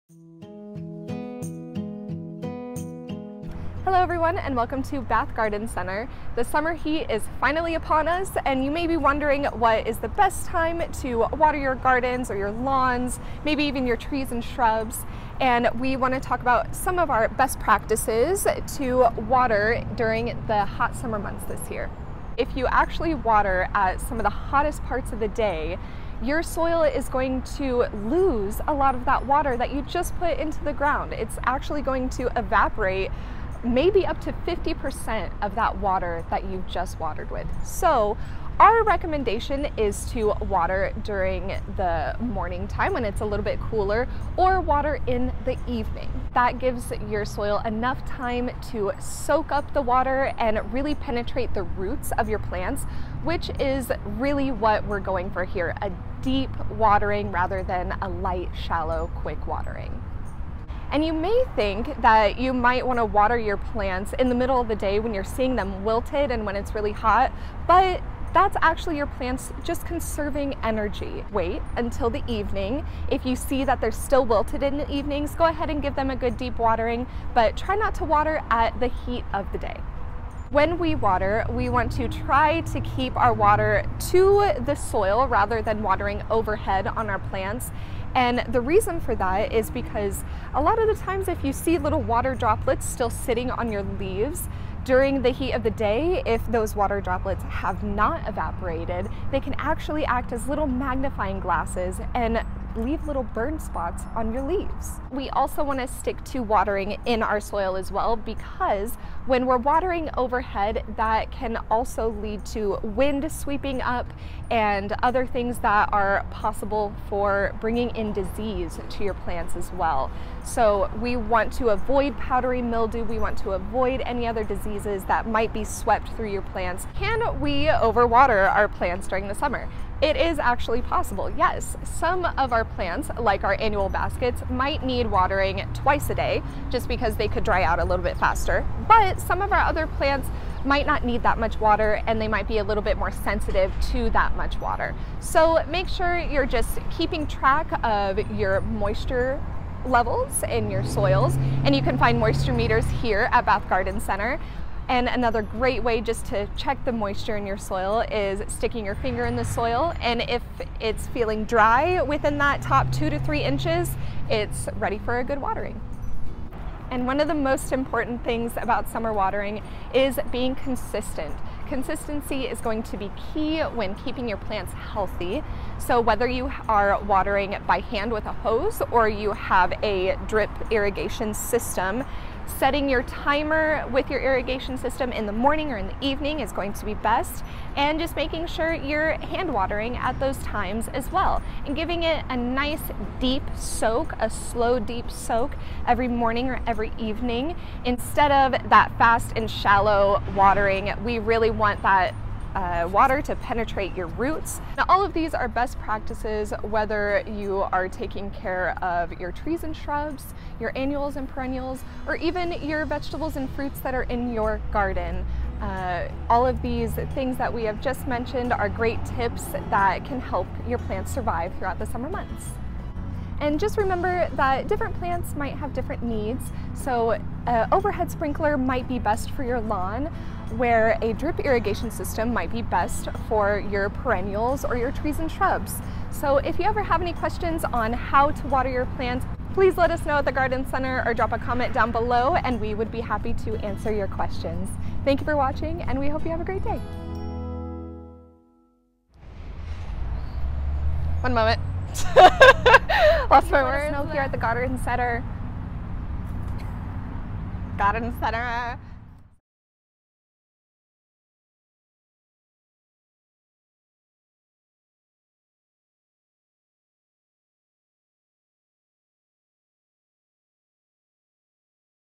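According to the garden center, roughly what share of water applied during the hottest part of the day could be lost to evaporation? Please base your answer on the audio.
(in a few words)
50%.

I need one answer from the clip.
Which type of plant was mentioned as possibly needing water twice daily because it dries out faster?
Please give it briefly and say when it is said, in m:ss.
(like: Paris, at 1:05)
annual baskets, at 2:13.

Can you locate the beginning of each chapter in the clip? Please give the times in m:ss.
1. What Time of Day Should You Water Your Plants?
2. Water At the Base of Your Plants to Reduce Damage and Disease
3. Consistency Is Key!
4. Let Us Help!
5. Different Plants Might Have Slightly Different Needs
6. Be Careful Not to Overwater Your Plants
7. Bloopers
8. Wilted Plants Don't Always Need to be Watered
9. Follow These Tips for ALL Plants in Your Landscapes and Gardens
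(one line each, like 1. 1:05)
1. 0:22
2. 1:20
3. 2:47
4. 3:56
5. 3:43
6. 2:07
7. 4:08
8. 1:01
9. 3:25.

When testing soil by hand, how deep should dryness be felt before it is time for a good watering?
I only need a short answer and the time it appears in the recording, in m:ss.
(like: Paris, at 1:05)
2 to 3 inches, at 2:42.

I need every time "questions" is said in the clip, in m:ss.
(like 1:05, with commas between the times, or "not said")
3:57, 4:04.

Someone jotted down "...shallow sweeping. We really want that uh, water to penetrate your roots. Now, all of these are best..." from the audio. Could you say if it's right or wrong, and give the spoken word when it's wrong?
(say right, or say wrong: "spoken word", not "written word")
wrong: "watering", not "sweeping".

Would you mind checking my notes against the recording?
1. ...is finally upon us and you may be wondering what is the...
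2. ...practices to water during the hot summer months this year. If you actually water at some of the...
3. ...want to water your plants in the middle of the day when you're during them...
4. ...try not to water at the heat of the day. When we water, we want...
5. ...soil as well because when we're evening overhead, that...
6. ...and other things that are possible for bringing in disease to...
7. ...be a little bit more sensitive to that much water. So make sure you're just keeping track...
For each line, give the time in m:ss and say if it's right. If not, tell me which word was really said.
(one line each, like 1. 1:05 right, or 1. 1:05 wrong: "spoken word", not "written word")
1. 0:07 right
2. 0:17 right
3. 1:02 wrong: "seeing", not "during"
4. 1:17 right
5. 1:47 wrong: "watering", not "evening"
6. 1:54 right
7. 2:22 right.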